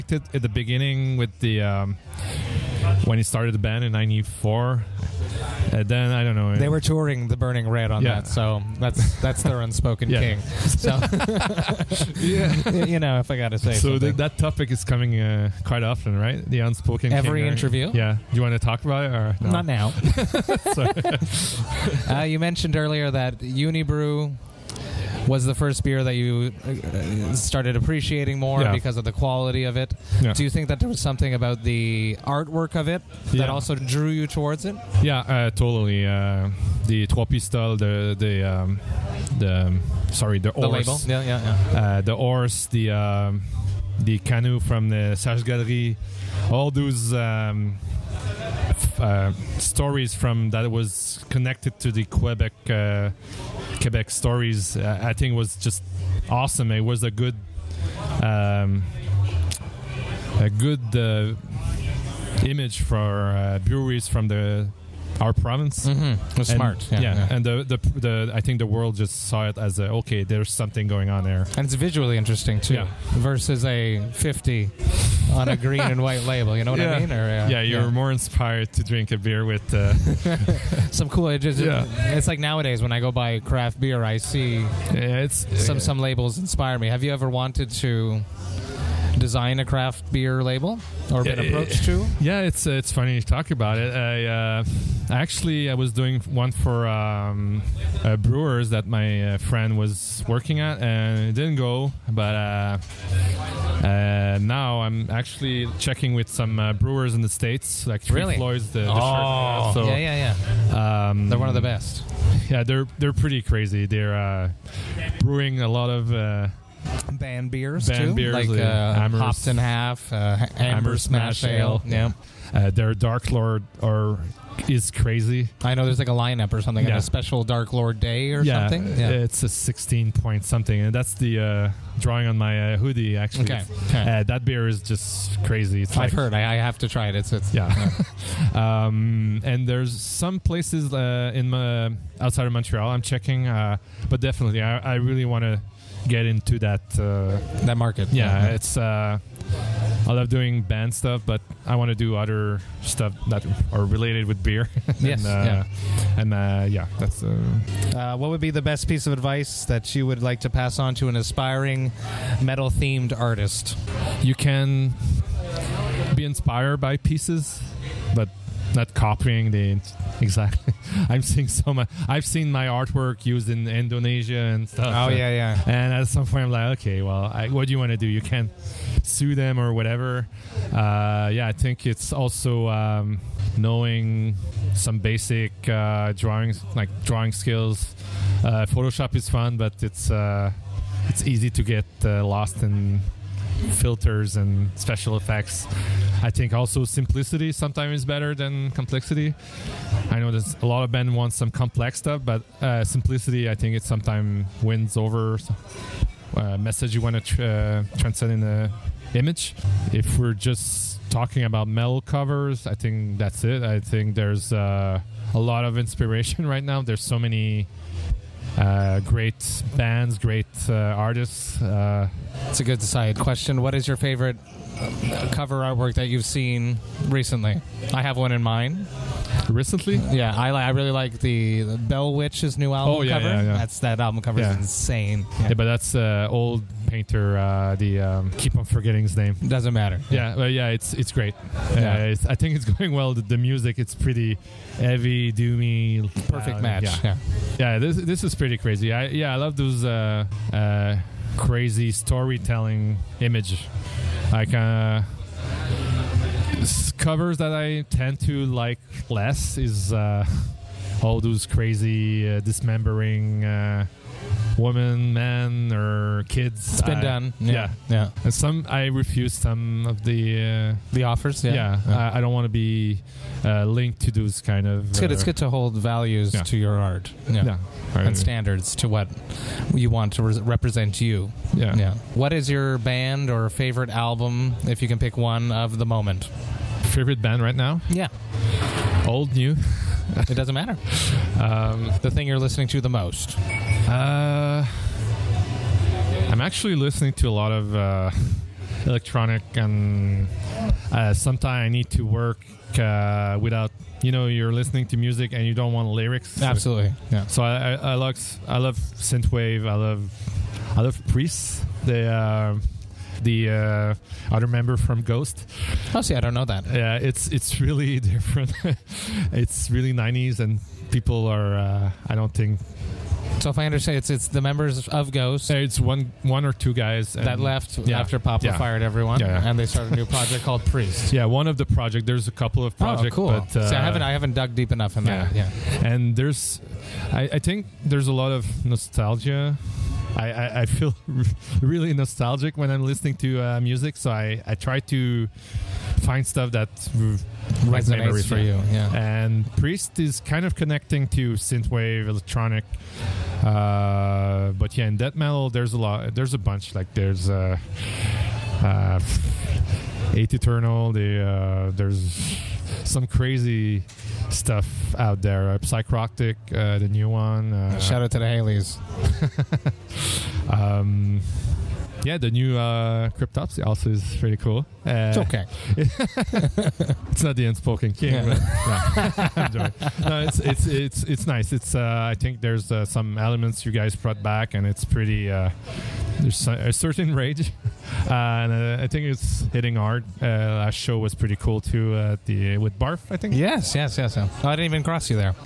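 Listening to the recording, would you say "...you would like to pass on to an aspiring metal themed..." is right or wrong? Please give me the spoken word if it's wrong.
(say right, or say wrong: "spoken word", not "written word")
right.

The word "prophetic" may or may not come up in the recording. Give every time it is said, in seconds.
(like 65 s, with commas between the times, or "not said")
not said.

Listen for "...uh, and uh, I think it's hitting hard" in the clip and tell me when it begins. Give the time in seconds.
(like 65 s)
388 s.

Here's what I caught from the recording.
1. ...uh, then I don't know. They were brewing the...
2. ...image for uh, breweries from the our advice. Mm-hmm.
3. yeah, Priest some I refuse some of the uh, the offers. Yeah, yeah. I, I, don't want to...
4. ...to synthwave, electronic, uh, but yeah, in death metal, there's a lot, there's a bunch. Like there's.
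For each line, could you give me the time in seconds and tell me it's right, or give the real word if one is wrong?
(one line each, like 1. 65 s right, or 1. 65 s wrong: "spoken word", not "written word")
1. 5 s wrong: "touring", not "brewing"
2. 62 s wrong: "province", not "advice"
3. 267 s wrong: "And", not "Priest"
4. 351 s right.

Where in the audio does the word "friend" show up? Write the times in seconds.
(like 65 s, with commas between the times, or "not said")
99 s.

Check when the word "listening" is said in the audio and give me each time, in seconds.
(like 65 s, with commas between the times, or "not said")
292 s, 296 s, 304 s, 342 s.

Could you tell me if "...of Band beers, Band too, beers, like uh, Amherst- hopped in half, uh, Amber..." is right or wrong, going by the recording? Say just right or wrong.
right.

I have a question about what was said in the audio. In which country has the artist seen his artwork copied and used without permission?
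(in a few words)
Indonesia.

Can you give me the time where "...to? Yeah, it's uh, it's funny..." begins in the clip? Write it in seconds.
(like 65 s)
91 s.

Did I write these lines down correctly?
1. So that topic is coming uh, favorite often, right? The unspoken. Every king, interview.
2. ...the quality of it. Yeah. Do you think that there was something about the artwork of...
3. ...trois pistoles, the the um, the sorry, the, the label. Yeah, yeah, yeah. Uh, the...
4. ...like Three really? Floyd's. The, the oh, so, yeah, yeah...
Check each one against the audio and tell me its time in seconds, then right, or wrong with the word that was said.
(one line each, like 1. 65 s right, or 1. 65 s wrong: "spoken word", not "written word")
1. 13 s wrong: "quite", not "favorite"
2. 29 s right
3. 37 s right
4. 107 s right.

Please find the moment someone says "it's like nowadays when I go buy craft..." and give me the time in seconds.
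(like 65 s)
82 s.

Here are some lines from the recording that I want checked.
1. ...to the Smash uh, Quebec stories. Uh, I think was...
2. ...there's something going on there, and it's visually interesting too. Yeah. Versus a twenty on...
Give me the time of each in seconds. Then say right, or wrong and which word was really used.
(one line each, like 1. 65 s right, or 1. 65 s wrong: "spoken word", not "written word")
1. 51 s wrong: "Quebec", not "Smash"
2. 70 s wrong: "fifty", not "twenty".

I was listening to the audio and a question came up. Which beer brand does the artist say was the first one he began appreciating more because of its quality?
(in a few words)
Unibroue.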